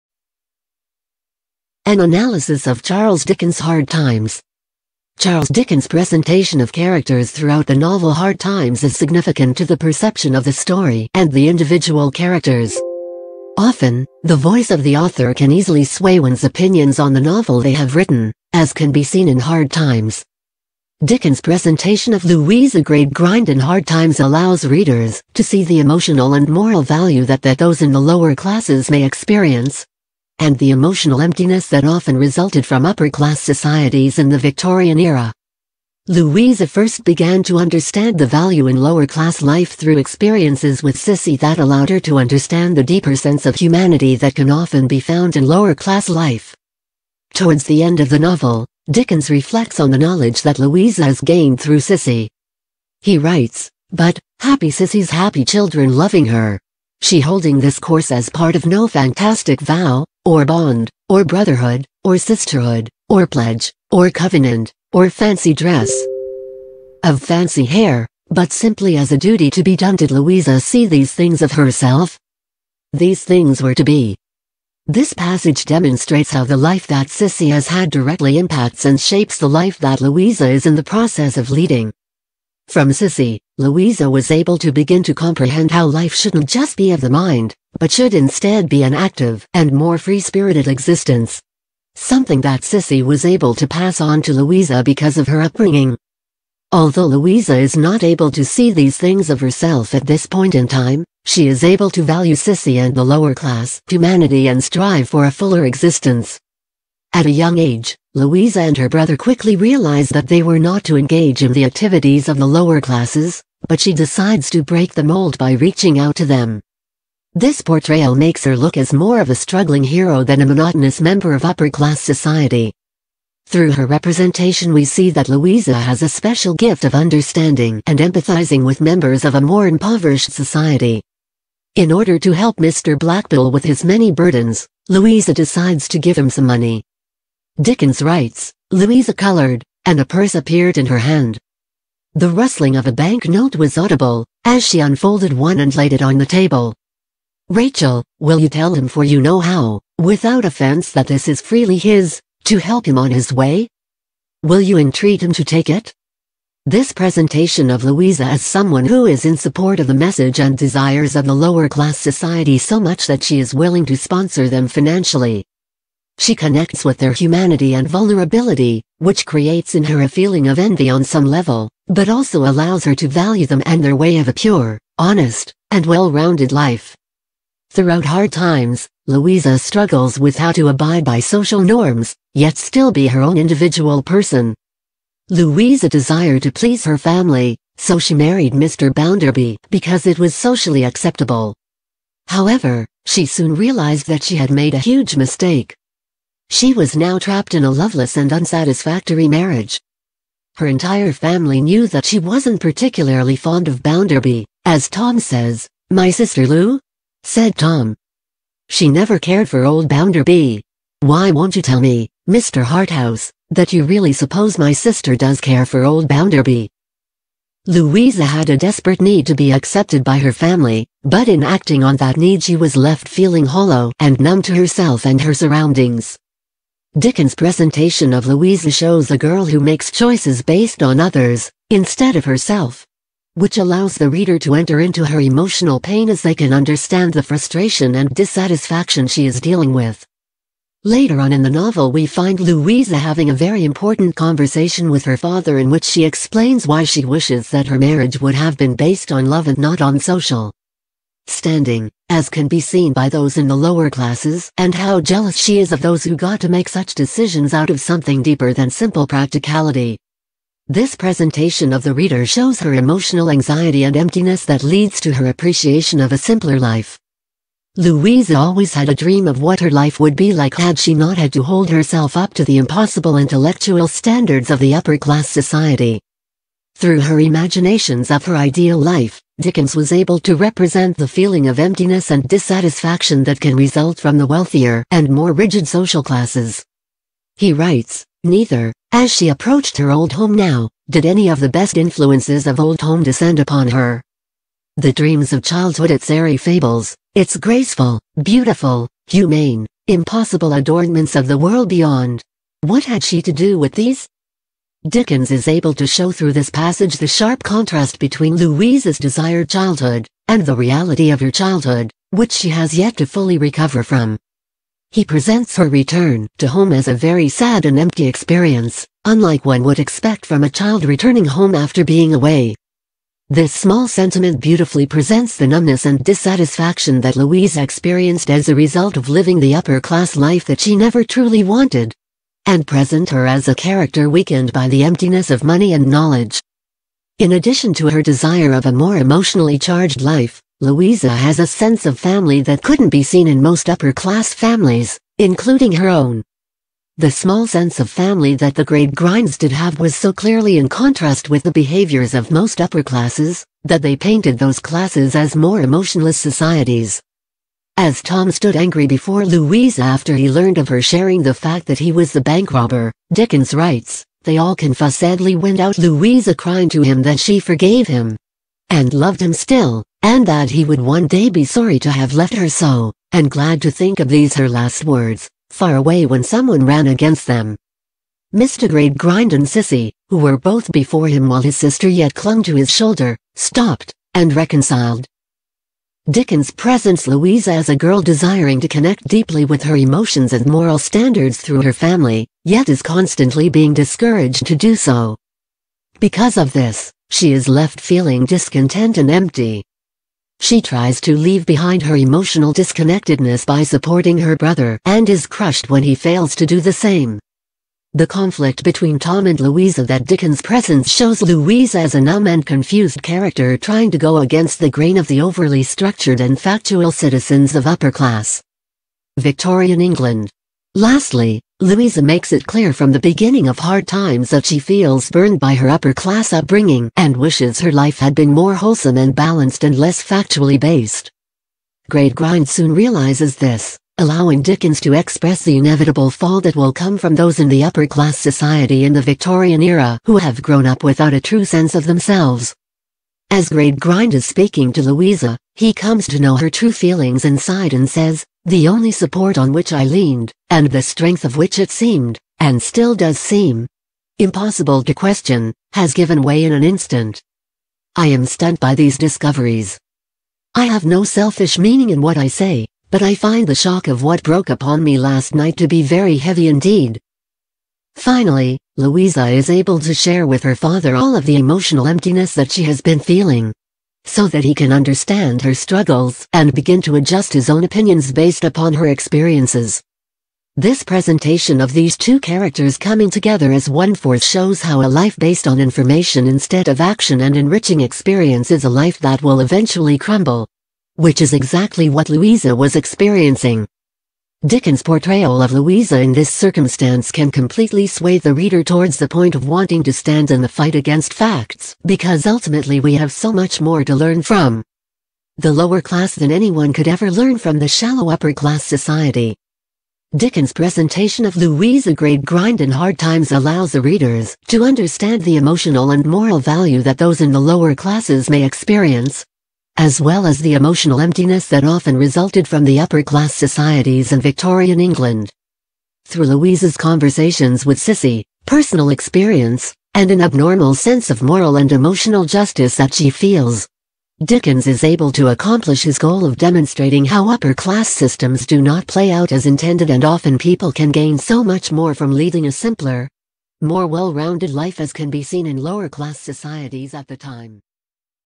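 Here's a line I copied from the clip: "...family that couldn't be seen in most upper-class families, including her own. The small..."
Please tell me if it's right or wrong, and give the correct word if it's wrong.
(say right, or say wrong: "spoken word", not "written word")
right.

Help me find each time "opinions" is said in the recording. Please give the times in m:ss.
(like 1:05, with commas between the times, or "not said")
0:16, 7:57.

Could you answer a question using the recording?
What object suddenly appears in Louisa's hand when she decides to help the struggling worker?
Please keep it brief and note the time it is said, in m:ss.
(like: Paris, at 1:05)
A purse, at 2:20.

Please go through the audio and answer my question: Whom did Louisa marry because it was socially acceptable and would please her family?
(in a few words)
Mr. Bounderby.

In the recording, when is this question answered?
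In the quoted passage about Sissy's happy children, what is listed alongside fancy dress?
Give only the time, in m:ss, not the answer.
1:07.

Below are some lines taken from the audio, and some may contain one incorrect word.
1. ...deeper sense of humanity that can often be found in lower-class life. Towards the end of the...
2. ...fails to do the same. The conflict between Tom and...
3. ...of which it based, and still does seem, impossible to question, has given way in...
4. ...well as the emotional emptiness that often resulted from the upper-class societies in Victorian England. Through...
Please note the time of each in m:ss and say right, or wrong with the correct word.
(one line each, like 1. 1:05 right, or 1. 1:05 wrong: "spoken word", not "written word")
1. 0:42 right
2. 6:45 right
3. 7:31 wrong: "seemed", not "based"
4. 8:40 right.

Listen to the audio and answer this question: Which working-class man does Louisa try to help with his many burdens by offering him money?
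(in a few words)
Mr. Blackpool.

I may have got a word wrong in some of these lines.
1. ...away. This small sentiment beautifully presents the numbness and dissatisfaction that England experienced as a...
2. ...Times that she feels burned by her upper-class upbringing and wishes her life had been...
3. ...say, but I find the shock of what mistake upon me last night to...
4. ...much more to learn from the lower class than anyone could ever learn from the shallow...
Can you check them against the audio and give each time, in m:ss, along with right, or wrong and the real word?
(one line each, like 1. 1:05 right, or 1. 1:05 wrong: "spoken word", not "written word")
1. 5:22 wrong: "Louise", not "England"
2. 7:03 right
3. 7:42 wrong: "broke", not "mistake"
4. 8:23 right.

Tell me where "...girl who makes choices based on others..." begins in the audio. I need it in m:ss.
3:49.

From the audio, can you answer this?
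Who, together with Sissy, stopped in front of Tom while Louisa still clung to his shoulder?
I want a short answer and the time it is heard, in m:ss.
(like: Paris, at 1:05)
Mr. Gradgrind, at 6:18.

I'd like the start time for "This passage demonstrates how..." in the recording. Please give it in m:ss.
1:14.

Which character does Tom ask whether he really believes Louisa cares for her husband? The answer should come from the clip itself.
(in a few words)
Mr. Harthouse.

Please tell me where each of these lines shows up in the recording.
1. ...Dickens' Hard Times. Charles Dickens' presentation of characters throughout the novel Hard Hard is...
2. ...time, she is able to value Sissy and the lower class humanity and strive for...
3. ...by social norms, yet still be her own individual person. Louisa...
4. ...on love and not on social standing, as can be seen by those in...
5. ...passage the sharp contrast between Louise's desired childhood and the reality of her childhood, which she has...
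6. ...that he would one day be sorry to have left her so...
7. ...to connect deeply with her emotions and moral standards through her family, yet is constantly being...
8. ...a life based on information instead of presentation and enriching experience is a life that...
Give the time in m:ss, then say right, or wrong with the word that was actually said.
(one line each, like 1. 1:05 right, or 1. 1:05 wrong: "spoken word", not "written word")
1. 0:03 wrong: "Times", not "Hard"
2. 1:40 right
3. 3:01 right
4. 4:09 right
5. 5:06 right
6. 6:10 right
7. 6:28 right
8. 8:04 wrong: "action", not "presentation".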